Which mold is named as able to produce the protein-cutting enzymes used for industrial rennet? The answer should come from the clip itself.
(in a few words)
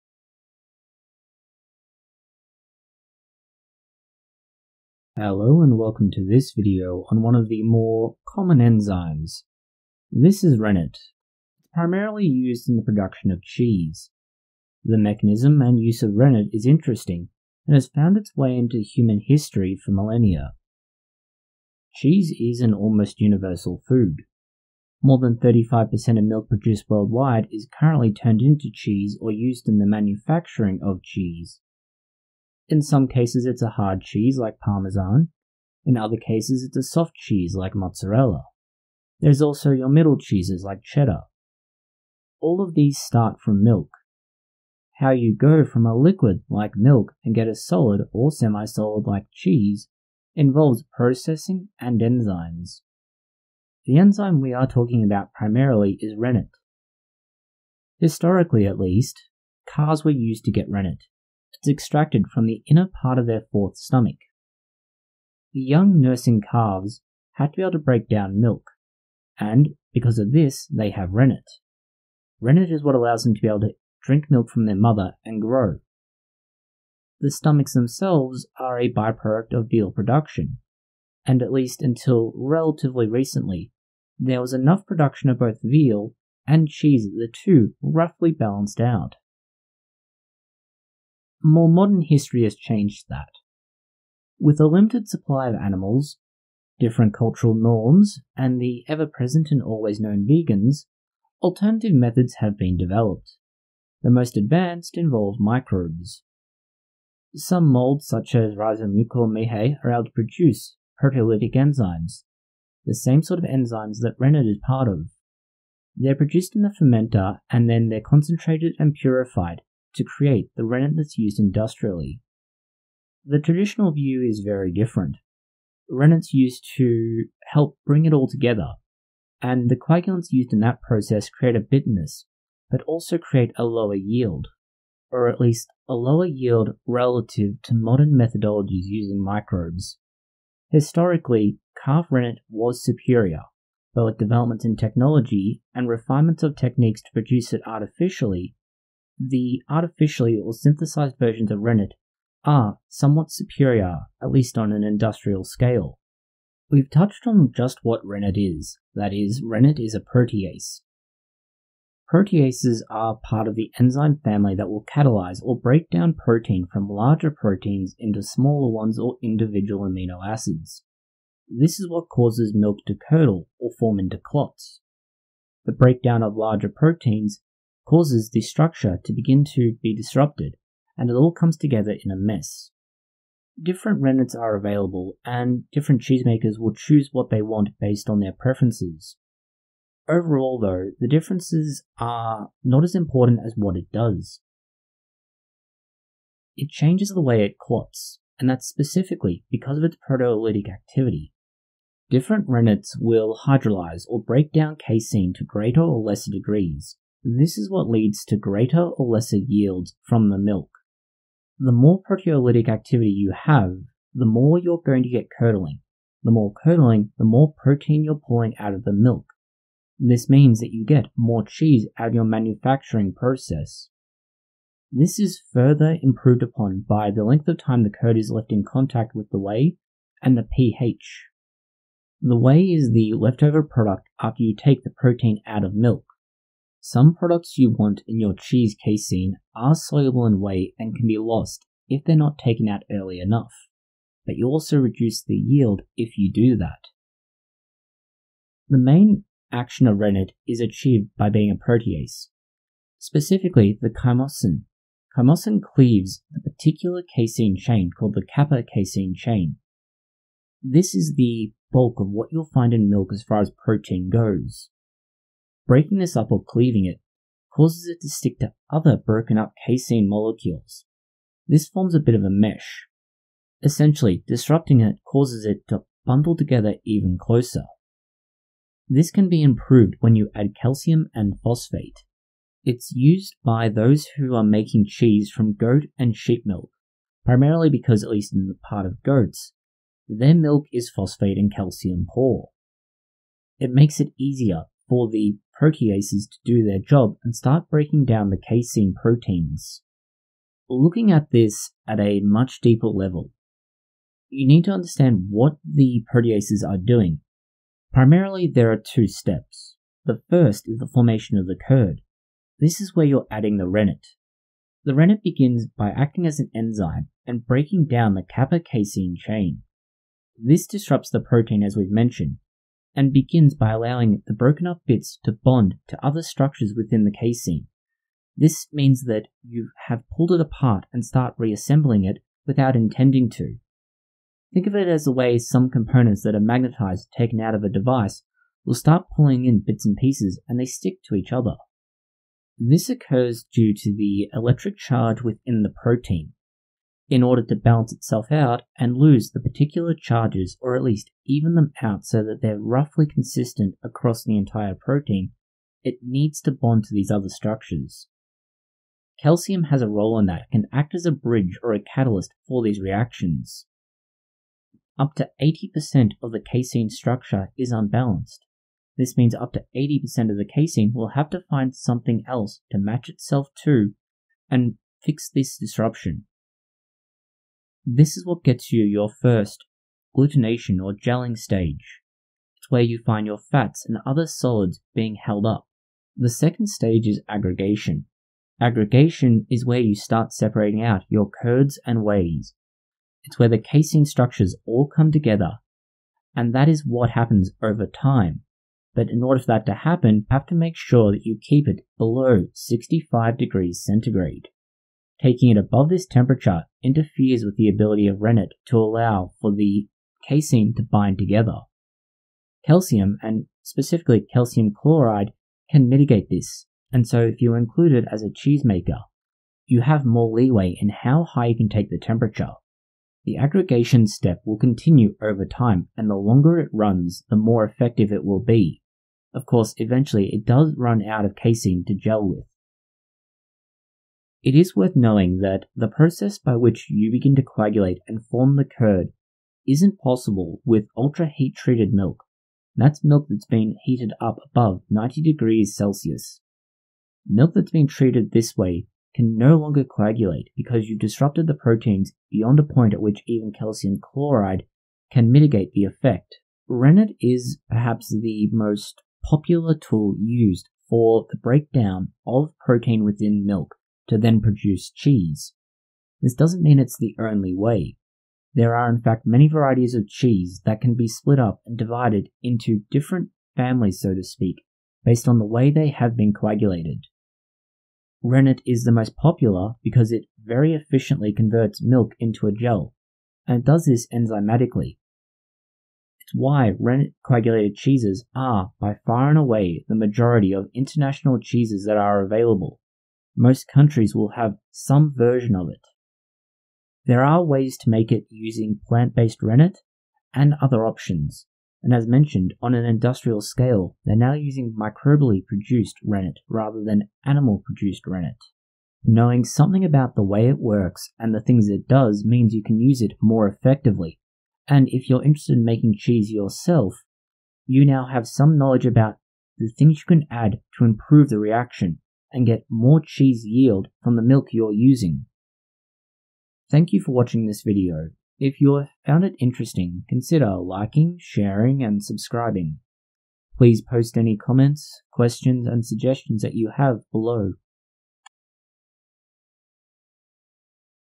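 Rhizomucor miehei.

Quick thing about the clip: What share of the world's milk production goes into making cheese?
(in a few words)
More than 35%.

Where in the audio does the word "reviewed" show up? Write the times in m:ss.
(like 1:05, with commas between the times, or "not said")
not said.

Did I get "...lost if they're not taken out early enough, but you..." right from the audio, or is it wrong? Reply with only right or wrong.
right.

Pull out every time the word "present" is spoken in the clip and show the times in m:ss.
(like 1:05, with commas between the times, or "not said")
1:39.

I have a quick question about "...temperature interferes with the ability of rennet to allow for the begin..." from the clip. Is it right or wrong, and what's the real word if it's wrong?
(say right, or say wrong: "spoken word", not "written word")
wrong: "casein", not "begin".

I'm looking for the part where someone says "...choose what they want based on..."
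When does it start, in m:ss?
3:06.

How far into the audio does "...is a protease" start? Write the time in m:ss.
2:39.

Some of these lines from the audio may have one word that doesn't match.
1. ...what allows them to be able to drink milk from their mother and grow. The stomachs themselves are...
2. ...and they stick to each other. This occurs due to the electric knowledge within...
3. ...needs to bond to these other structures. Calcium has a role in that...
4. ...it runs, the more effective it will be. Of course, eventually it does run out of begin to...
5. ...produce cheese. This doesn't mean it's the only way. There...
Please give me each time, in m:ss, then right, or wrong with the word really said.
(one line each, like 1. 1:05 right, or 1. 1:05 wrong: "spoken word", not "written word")
1. 1:12 right
2. 5:40 wrong: "charge", not "knowledge"
3. 5:56 right
4. 7:06 wrong: "casein", not "begin"
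5. 7:44 right.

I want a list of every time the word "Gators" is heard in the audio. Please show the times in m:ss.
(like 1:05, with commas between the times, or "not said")
not said.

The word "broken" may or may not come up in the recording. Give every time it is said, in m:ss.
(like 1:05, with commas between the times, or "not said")
4:28, 5:24.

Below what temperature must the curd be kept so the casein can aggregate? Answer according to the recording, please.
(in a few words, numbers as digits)
65 degrees Celsius.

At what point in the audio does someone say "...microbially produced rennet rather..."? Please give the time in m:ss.
8:24.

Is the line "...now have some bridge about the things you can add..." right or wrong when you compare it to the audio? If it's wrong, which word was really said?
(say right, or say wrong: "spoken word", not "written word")
wrong: "knowledge", not "bridge".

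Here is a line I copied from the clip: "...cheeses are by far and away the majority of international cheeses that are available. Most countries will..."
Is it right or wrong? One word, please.
right.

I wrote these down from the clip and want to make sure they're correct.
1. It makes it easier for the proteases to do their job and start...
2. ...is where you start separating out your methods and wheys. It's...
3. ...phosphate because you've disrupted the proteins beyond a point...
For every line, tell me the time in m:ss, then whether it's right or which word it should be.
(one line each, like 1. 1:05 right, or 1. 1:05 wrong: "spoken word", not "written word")
1. 4:53 right
2. 6:29 wrong: "curds", not "methods"
3. 7:29 wrong: "coagulate", not "phosphate".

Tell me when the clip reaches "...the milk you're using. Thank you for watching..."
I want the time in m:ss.
8:44.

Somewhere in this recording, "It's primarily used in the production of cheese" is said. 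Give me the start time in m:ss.
0:11.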